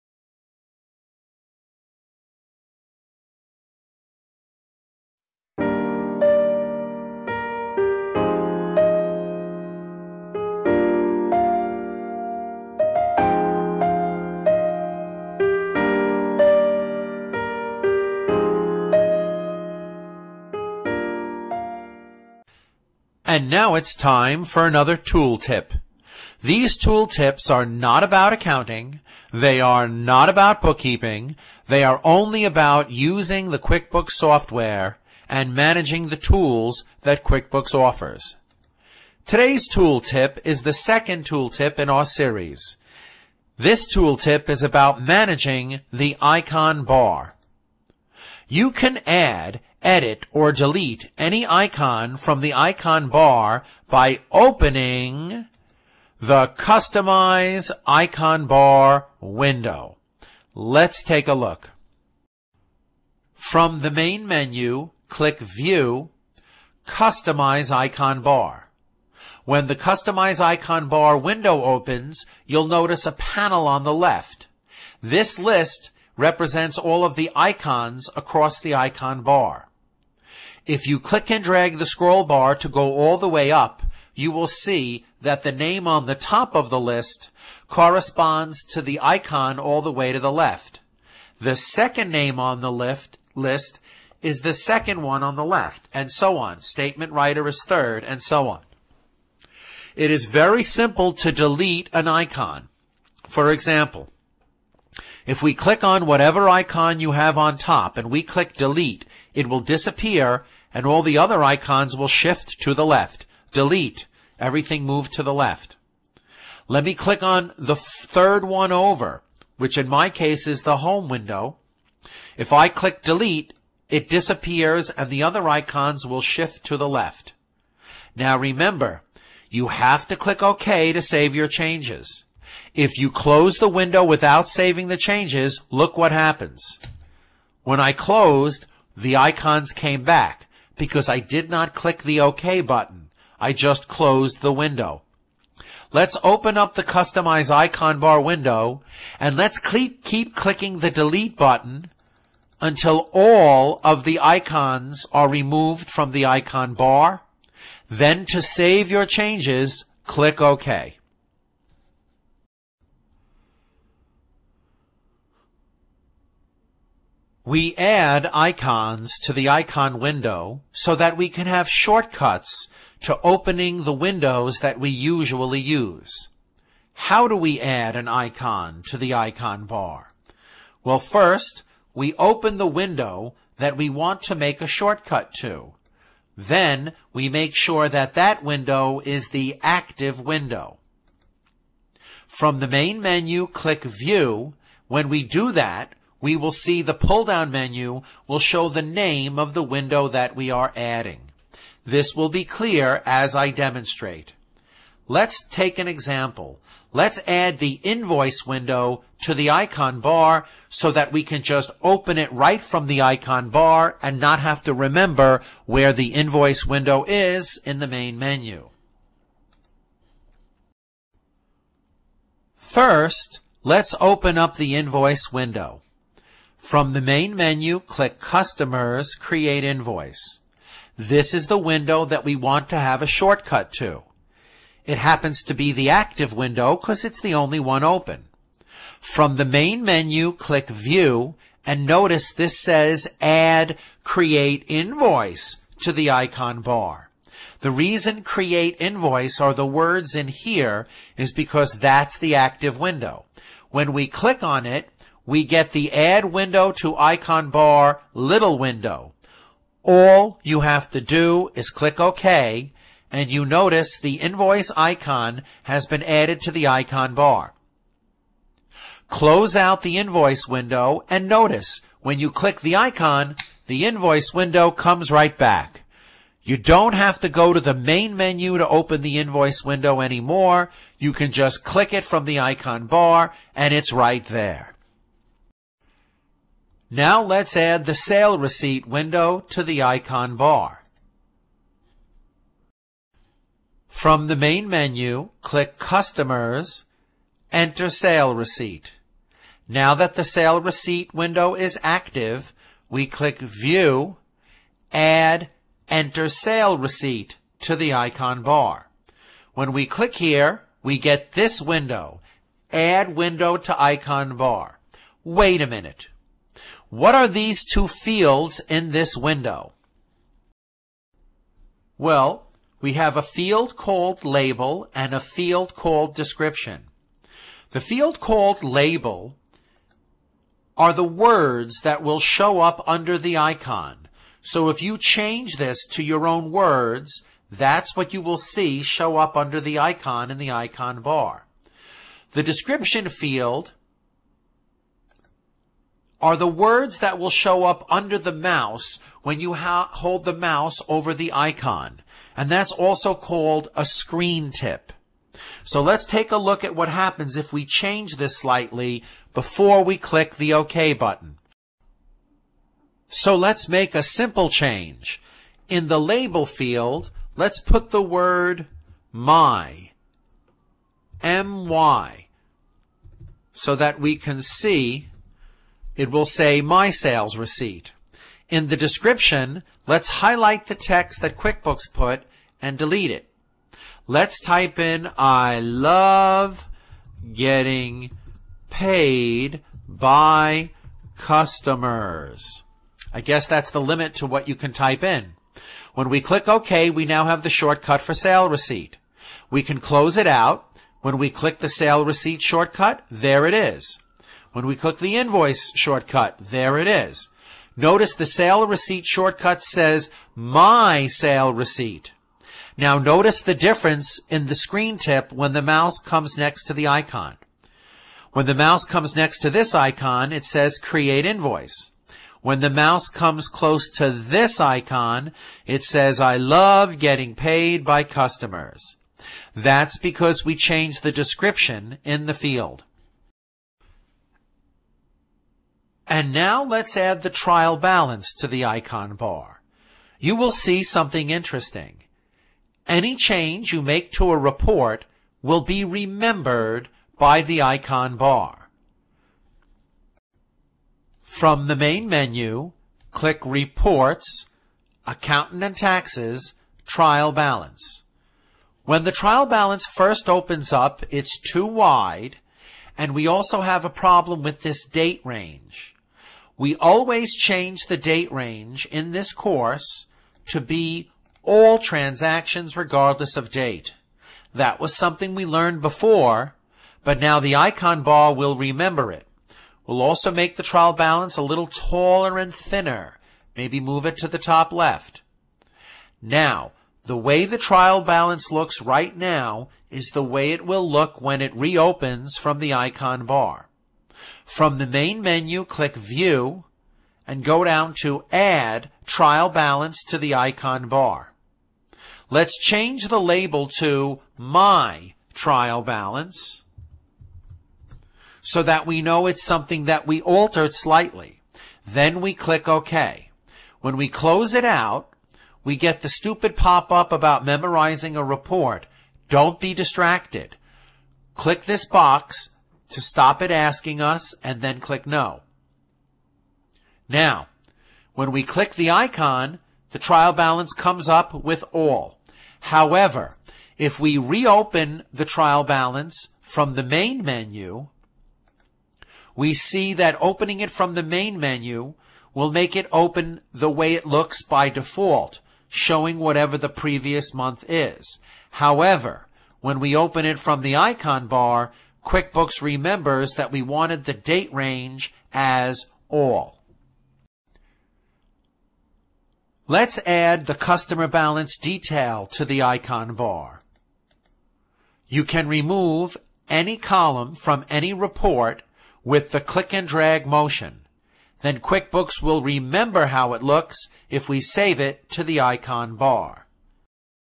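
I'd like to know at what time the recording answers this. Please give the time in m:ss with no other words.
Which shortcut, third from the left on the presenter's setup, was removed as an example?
2:00.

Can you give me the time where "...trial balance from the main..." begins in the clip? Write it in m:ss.
8:55.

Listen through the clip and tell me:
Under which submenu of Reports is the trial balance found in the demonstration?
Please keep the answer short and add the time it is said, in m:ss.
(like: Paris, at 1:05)
Accountant and Taxes, at 7:35.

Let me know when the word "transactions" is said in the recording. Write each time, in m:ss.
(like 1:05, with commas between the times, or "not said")
7:51.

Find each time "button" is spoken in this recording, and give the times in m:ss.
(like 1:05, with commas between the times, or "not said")
2:22, 2:31, 6:00.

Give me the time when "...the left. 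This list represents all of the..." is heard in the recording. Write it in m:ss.
1:13.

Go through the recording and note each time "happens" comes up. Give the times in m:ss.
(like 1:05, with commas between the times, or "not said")
2:16, 3:54, 5:56.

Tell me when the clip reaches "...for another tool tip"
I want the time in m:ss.
0:24.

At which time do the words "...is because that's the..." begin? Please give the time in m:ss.
4:11.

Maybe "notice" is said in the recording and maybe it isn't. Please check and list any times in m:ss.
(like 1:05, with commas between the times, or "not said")
1:12, 4:01, 4:23, 4:31, 6:47, 6:52.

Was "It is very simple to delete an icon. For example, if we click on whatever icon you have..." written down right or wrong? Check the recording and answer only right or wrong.
right.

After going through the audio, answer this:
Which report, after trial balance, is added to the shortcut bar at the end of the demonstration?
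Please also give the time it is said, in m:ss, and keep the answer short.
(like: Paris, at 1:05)
Customer balance detail, at 9:20.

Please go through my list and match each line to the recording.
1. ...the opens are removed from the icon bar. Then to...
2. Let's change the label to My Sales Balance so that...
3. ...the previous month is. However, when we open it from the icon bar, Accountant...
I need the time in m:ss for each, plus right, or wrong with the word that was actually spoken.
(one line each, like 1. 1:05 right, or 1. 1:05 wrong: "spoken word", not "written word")
1. 2:34 wrong: "icons", not "opens"
2. 8:22 wrong: "Trial", not "Sales"
3. 9:06 wrong: "QuickBooks", not "Accountant".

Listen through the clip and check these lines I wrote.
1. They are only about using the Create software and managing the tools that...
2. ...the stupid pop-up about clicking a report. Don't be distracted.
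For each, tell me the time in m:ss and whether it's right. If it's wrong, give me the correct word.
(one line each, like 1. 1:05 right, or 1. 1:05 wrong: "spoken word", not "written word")
1. 0:31 wrong: "QuickBooks", not "Create"
2. 8:36 wrong: "memorizing", not "clicking".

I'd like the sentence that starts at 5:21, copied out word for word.
Well, we have a field called label and a field called description.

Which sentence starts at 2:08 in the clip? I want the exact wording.
Now remember, you have to click OK to save your changes.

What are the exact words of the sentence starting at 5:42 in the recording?
The description field are the words that will show up under the mouse when you hold the mouse over the icon.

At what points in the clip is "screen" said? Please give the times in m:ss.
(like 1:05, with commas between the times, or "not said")
5:53, 6:54.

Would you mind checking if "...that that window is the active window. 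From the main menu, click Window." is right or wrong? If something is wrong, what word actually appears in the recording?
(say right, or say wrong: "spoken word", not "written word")
wrong: "View", not "Window".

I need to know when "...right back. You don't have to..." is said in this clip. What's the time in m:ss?
4:35.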